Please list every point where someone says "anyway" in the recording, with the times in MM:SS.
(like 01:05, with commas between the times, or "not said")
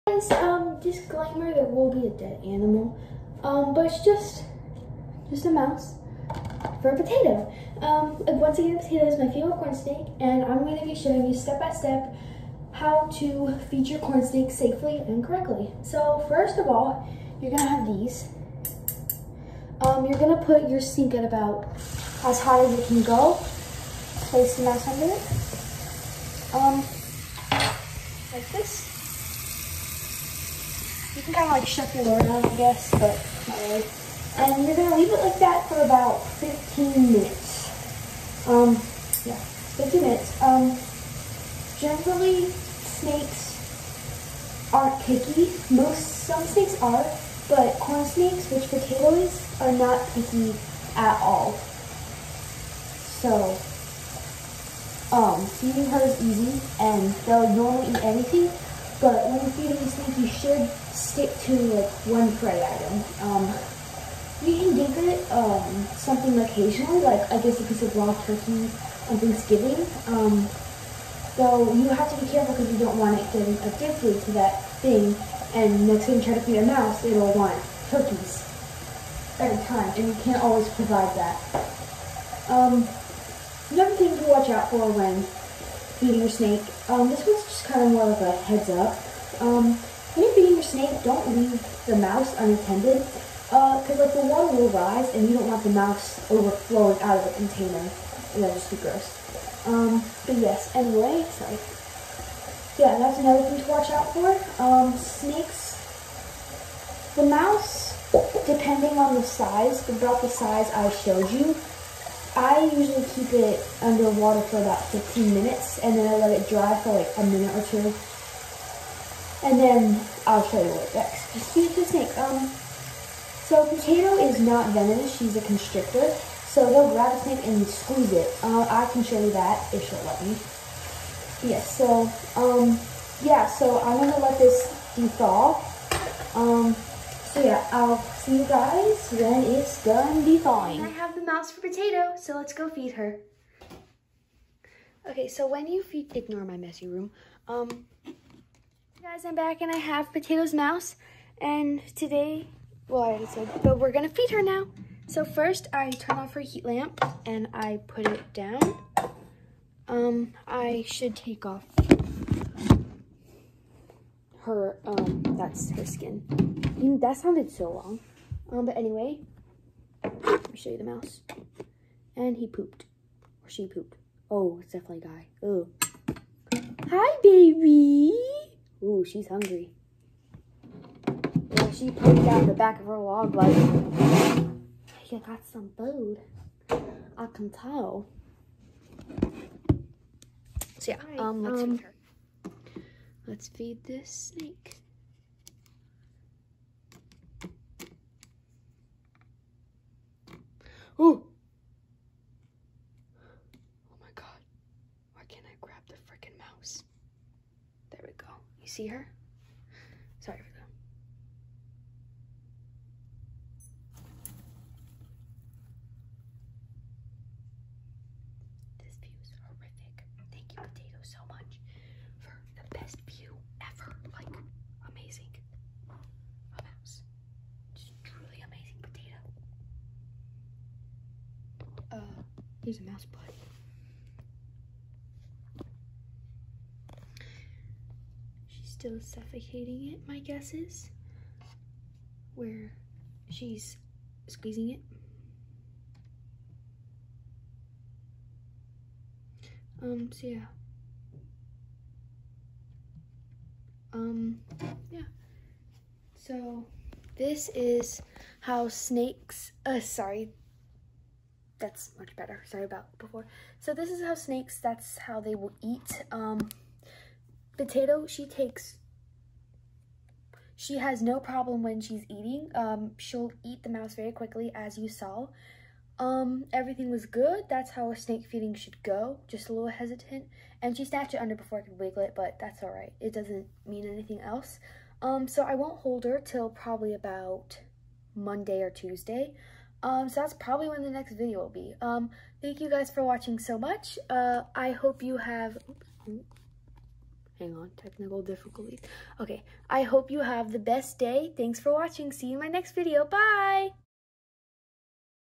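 01:40, 02:48.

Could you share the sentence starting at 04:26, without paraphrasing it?
Um, potato, she takes, she has no problem when she's eating.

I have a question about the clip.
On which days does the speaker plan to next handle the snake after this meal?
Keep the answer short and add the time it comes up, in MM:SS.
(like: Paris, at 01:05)
Monday or Tuesday, at 04:48.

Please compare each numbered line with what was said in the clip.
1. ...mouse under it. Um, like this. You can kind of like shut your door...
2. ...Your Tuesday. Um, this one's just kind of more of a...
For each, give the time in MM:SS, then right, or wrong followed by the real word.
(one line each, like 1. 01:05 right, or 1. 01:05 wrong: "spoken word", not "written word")
1. 00:24 right
2. 01:26 wrong: "Snake", not "Tuesday".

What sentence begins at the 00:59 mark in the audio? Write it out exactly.
But when feeding these things, you should stick to like one prey item.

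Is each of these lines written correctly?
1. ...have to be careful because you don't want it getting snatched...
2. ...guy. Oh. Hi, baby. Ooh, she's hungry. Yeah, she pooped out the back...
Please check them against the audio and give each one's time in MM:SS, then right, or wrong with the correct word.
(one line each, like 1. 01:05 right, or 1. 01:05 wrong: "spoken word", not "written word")
1. 01:11 wrong: "addicted", not "snatched"
2. 02:55 right.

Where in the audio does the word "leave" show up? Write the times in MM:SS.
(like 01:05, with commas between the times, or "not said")
00:34, 01:31.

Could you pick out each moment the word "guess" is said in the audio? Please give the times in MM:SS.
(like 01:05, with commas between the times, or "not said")
00:32, 01:07, 04:00.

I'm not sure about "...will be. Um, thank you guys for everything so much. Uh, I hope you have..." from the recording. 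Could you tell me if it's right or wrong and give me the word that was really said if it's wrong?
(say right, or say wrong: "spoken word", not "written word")
wrong: "watching", not "everything".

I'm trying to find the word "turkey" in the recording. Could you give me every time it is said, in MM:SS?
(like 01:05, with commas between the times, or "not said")
01:08, 01:17.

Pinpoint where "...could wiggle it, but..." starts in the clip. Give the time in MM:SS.
04:41.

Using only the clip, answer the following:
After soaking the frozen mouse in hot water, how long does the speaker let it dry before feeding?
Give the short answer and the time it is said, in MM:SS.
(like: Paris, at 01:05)
a minute or two, at 01:57.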